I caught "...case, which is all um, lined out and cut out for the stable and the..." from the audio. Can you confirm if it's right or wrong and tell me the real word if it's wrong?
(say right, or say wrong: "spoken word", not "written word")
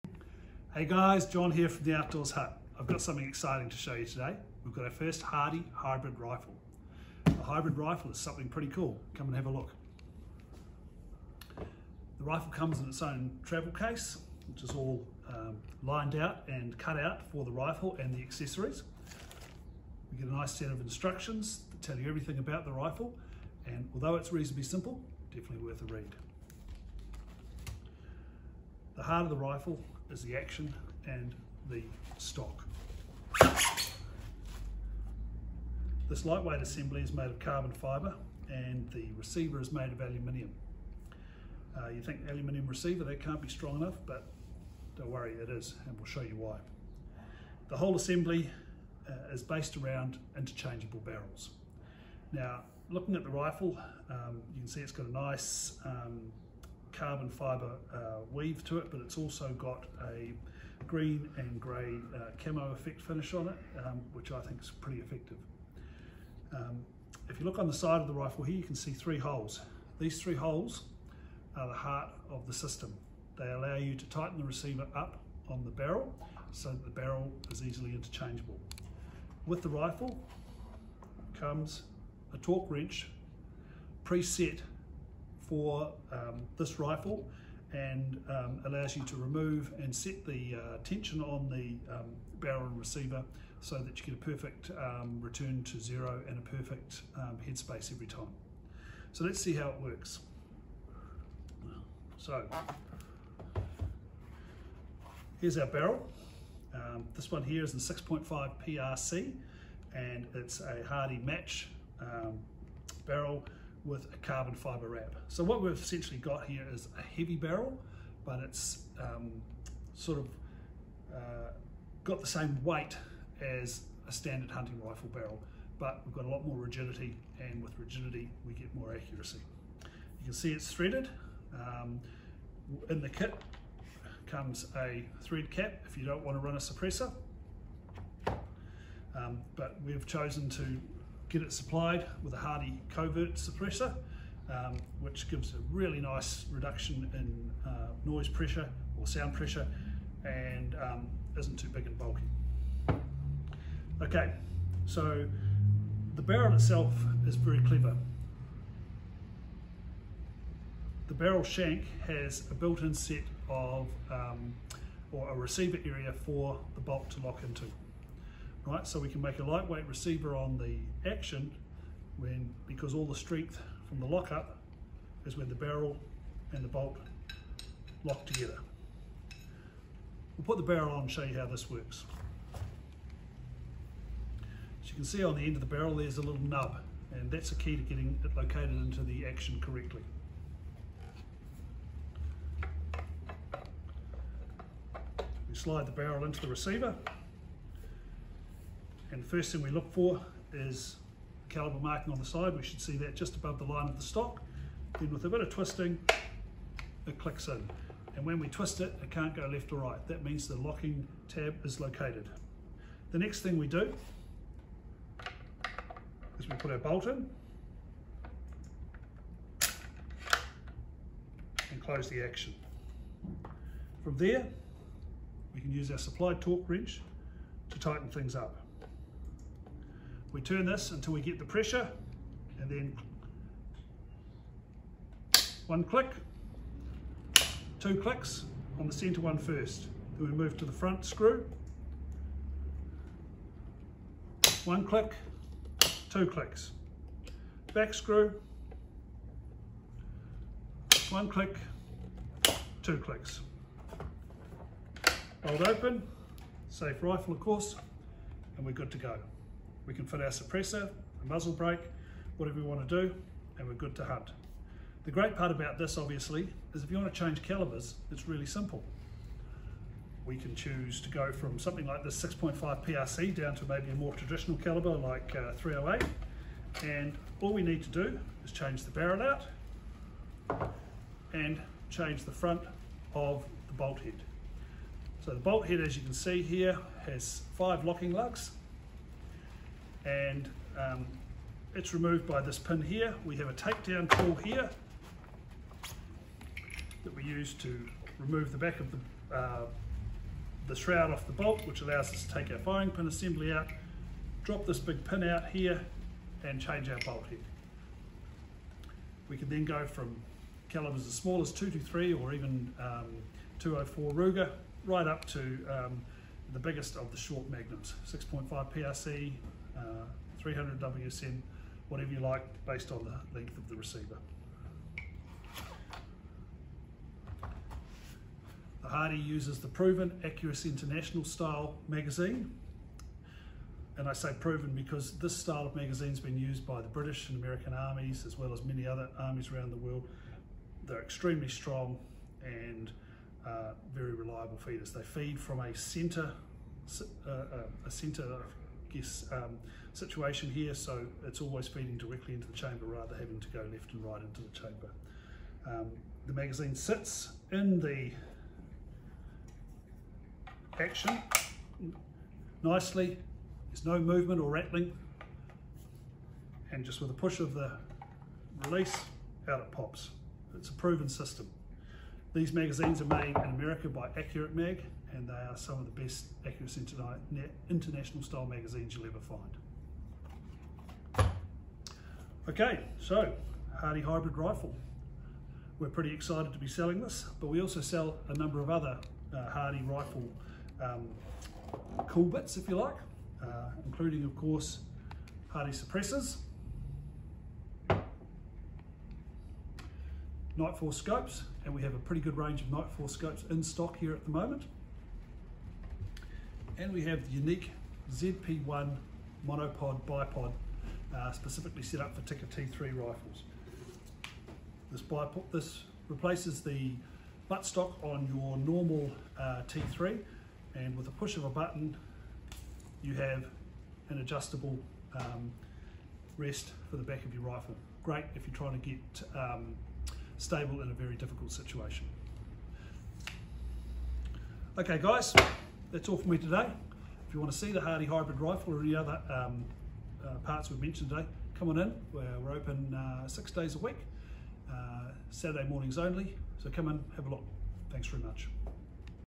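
wrong: "rifle", not "stable".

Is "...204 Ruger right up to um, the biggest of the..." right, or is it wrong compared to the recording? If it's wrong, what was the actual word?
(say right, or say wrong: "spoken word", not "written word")
right.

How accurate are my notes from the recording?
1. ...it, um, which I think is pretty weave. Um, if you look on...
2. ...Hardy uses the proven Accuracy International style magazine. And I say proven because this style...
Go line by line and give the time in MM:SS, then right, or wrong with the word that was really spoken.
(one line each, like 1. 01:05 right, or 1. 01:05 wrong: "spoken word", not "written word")
1. 01:03 wrong: "effective", not "weave"
2. 05:28 right.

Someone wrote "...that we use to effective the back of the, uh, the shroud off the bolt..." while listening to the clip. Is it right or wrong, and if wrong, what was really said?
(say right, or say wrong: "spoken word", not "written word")
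wrong: "remove", not "effective".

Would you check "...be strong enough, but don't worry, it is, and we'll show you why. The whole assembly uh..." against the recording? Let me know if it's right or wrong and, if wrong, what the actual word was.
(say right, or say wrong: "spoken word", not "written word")
right.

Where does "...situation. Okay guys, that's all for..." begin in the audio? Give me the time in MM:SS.
07:11.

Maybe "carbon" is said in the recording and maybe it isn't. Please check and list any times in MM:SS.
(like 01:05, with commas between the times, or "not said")
00:37, 00:57, 01:54.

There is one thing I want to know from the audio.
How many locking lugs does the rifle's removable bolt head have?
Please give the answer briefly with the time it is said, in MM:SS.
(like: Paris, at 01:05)
5, at 04:47.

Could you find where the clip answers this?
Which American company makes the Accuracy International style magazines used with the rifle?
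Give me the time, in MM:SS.
06:14.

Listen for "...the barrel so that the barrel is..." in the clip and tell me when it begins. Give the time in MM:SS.
01:15.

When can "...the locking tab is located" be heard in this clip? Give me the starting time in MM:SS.
03:30.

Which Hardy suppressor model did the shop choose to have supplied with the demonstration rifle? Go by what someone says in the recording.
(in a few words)
Hardy Covert.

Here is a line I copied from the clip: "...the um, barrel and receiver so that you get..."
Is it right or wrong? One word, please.
right.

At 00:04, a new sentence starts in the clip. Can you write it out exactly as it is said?
We've got our first Hardy hybrid rifle.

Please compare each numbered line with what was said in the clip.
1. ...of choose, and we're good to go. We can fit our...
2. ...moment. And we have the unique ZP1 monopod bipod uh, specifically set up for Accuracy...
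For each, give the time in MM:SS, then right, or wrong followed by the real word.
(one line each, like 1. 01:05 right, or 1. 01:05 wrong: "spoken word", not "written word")
1. 04:17 wrong: "course", not "choose"
2. 06:44 wrong: "Tikka", not "Accuracy".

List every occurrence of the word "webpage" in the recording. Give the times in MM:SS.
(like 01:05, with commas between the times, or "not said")
not said.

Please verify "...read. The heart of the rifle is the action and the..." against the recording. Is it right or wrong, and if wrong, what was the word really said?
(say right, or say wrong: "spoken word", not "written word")
right.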